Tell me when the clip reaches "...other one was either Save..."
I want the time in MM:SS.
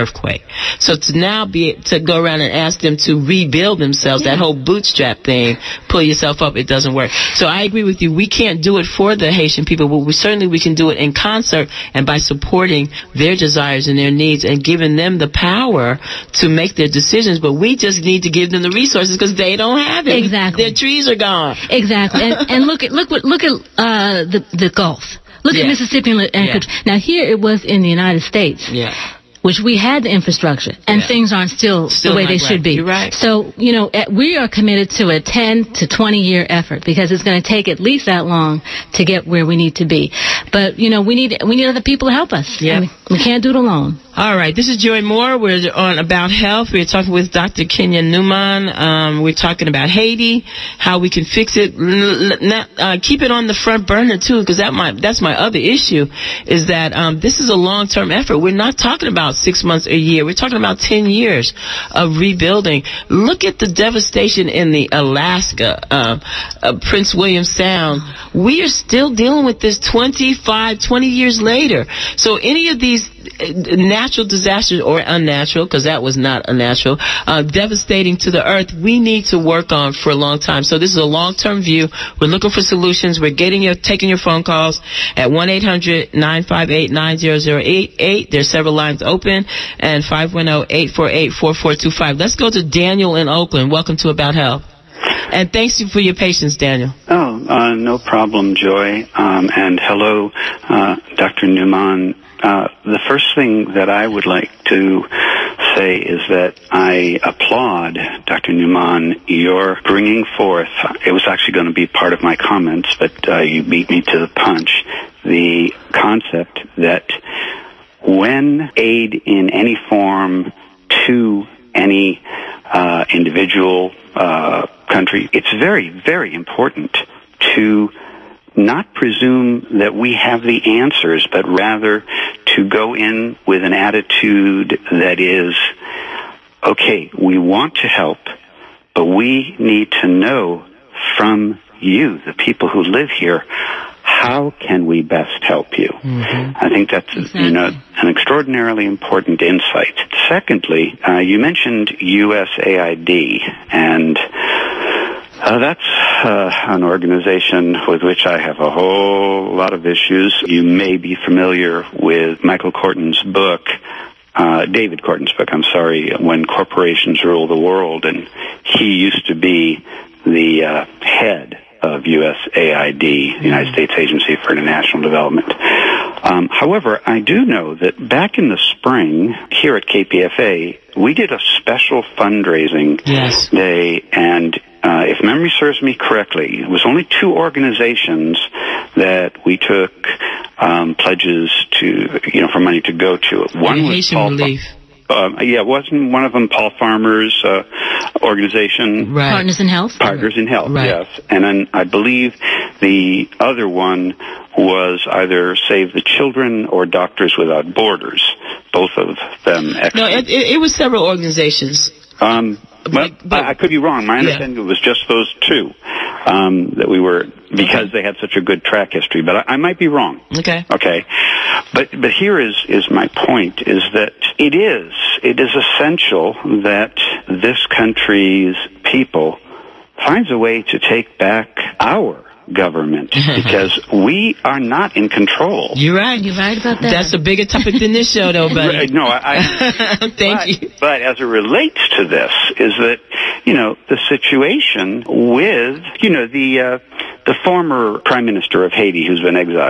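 03:23.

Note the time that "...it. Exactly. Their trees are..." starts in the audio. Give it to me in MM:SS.
00:20.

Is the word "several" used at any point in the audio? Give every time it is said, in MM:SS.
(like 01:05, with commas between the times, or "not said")
01:28, 03:30.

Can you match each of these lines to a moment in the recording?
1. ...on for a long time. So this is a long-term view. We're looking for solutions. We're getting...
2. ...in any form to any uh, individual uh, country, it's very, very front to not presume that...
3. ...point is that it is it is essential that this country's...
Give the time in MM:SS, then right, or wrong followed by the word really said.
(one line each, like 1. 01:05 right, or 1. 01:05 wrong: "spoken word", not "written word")
1. 01:19 right
2. 01:59 wrong: "important", not "front"
3. 03:43 right.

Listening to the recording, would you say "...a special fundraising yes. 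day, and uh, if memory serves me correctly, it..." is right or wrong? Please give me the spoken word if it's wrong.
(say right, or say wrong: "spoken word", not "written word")
right.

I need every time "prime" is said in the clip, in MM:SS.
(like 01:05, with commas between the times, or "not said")
04:07.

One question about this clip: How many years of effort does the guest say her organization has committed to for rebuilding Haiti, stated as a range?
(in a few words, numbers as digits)
10 to 20 years.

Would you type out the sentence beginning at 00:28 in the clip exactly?
Yeah which we had the infrastructure, and yeah.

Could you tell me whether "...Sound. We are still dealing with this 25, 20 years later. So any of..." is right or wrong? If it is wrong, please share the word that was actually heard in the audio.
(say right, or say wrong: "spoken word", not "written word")
right.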